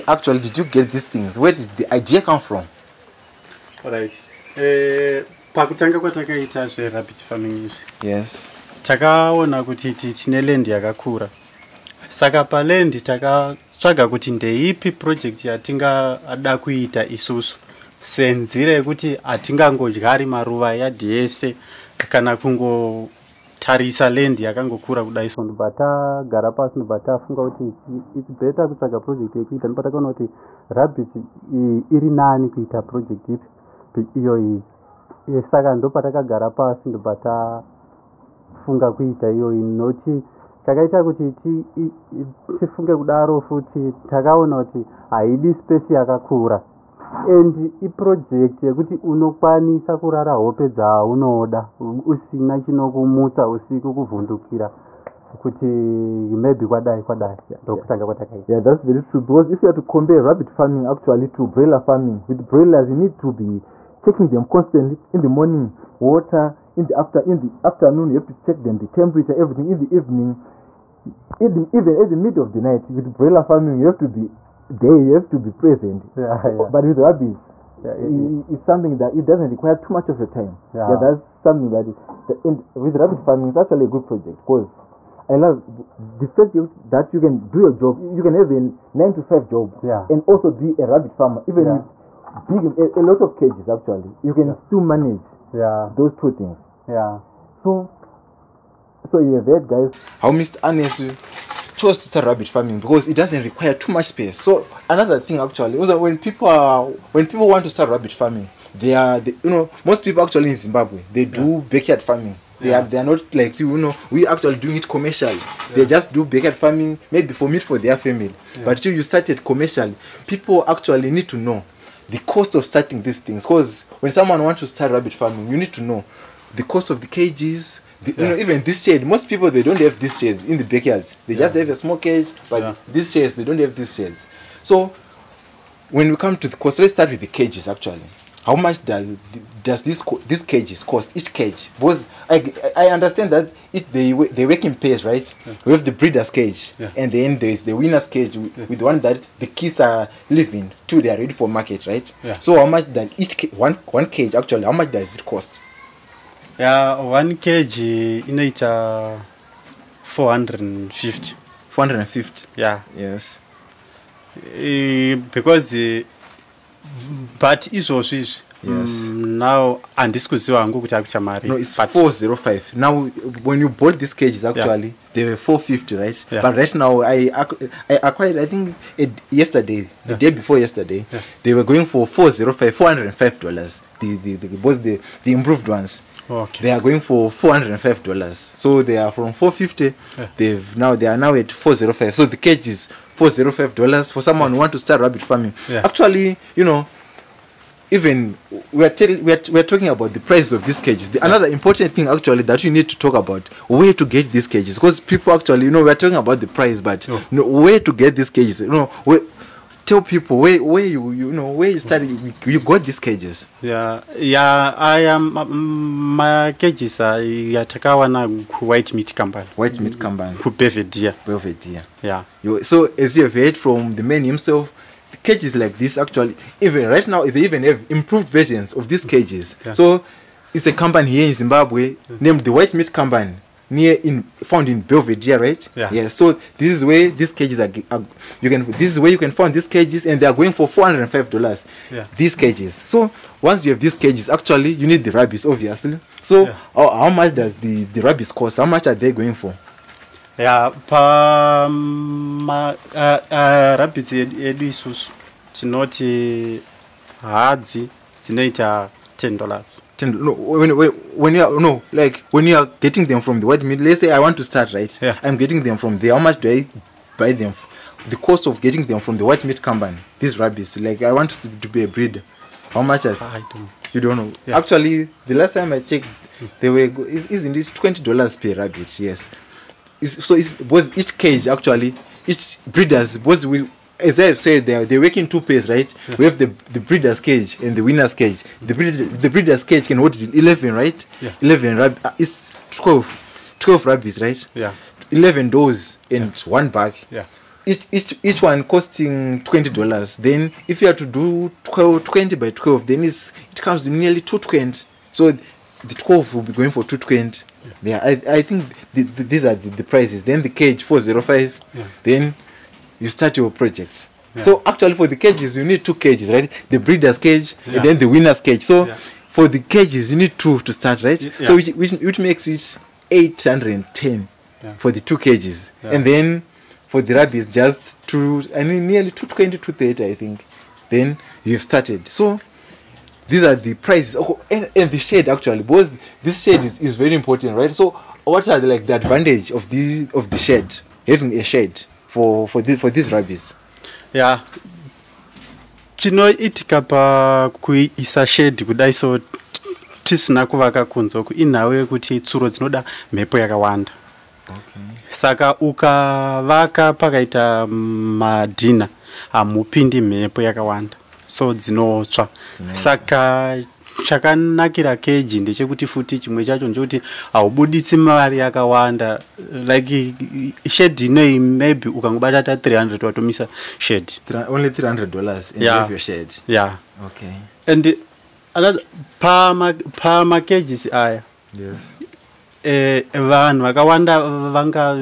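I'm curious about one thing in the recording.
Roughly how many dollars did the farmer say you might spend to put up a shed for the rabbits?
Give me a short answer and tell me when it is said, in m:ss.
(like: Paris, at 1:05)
300, at 6:12.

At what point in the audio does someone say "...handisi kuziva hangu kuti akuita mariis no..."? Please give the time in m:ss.
2:49.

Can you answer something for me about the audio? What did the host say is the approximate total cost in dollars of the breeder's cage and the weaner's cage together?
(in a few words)
810.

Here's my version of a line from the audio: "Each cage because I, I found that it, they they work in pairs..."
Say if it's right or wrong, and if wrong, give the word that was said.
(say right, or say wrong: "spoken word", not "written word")
wrong: "understand", not "found".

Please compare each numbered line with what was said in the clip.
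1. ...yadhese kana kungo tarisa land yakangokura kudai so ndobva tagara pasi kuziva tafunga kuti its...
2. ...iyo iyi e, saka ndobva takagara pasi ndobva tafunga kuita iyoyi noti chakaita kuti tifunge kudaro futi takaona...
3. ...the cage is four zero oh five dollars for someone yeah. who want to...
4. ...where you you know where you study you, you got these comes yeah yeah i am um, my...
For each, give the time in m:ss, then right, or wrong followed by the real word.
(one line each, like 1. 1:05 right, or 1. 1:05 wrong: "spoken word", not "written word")
1. 0:20 wrong: "ndobva", not "kuziva"
2. 0:34 right
3. 3:12 right
4. 3:30 wrong: "cages", not "comes".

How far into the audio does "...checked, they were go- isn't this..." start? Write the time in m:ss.
4:35.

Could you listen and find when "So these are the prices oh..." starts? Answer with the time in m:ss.
5:32.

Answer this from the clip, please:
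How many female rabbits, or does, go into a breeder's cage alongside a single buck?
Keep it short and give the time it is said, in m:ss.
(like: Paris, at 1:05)
11, at 4:55.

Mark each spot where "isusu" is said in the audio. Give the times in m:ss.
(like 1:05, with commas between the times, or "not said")
0:17, 4:14.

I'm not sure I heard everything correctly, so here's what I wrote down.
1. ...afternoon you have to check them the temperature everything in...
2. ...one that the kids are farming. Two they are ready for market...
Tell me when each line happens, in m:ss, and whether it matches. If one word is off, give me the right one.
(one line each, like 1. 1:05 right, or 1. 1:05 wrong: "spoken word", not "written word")
1. 1:07 right
2. 2:28 wrong: "living", not "farming".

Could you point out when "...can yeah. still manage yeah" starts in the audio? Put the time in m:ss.
1:34.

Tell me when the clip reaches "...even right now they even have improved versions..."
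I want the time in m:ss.
3:46.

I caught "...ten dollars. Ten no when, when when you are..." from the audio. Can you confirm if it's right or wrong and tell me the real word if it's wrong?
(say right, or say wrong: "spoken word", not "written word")
right.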